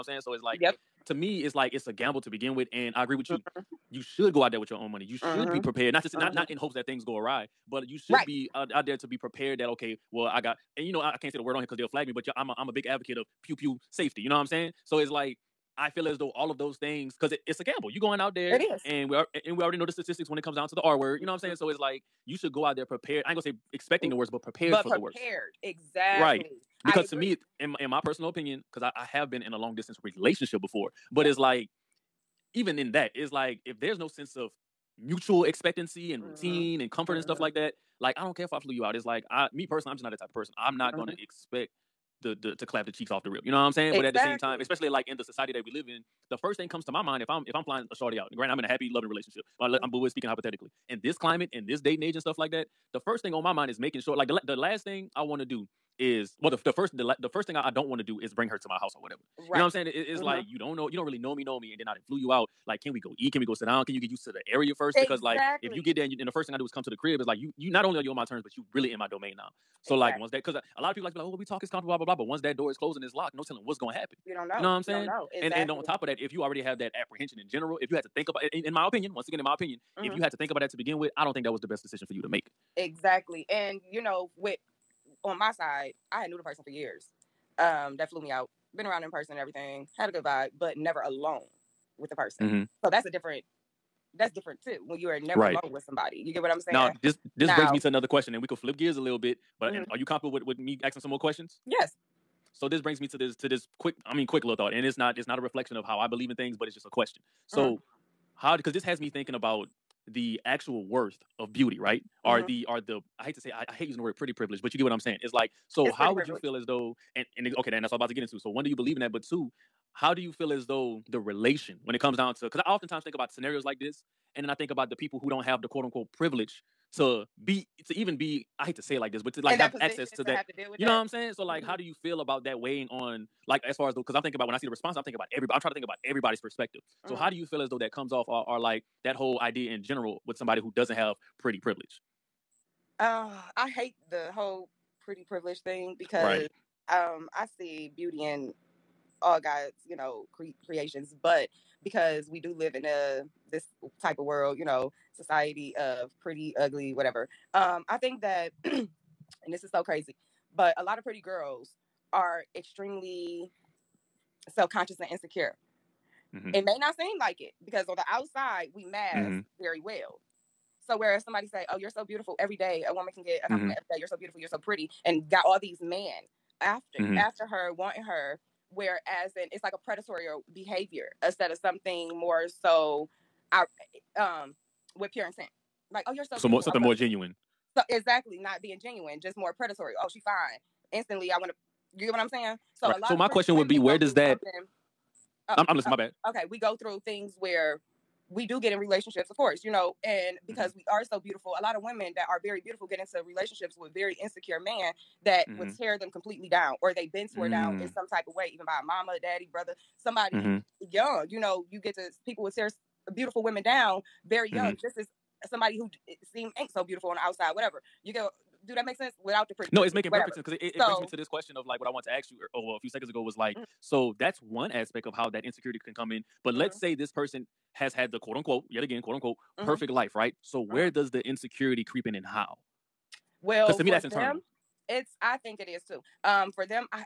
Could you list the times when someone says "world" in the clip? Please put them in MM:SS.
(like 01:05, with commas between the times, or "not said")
02:34.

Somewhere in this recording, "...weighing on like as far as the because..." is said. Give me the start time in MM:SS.
02:12.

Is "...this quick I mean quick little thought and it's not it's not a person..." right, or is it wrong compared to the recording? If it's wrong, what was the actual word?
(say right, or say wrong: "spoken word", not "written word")
wrong: "reflection", not "person".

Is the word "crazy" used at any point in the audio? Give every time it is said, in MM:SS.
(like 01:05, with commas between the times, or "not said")
02:39.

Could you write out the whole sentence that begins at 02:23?
Uh, I hate the whole pretty privilege thing because right.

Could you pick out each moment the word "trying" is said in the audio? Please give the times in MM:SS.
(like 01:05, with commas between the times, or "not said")
02:15.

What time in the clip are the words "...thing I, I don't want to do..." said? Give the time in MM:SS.
00:57.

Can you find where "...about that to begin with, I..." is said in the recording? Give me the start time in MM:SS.
01:20.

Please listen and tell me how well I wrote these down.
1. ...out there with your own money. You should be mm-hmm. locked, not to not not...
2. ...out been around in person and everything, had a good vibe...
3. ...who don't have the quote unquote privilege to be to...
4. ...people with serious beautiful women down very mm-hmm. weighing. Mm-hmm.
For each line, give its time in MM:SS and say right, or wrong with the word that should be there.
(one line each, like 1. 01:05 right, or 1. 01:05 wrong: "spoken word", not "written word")
1. 00:04 wrong: "prepared", not "locked"
2. 01:28 right
3. 02:05 right
4. 03:32 wrong: "young", not "weighing".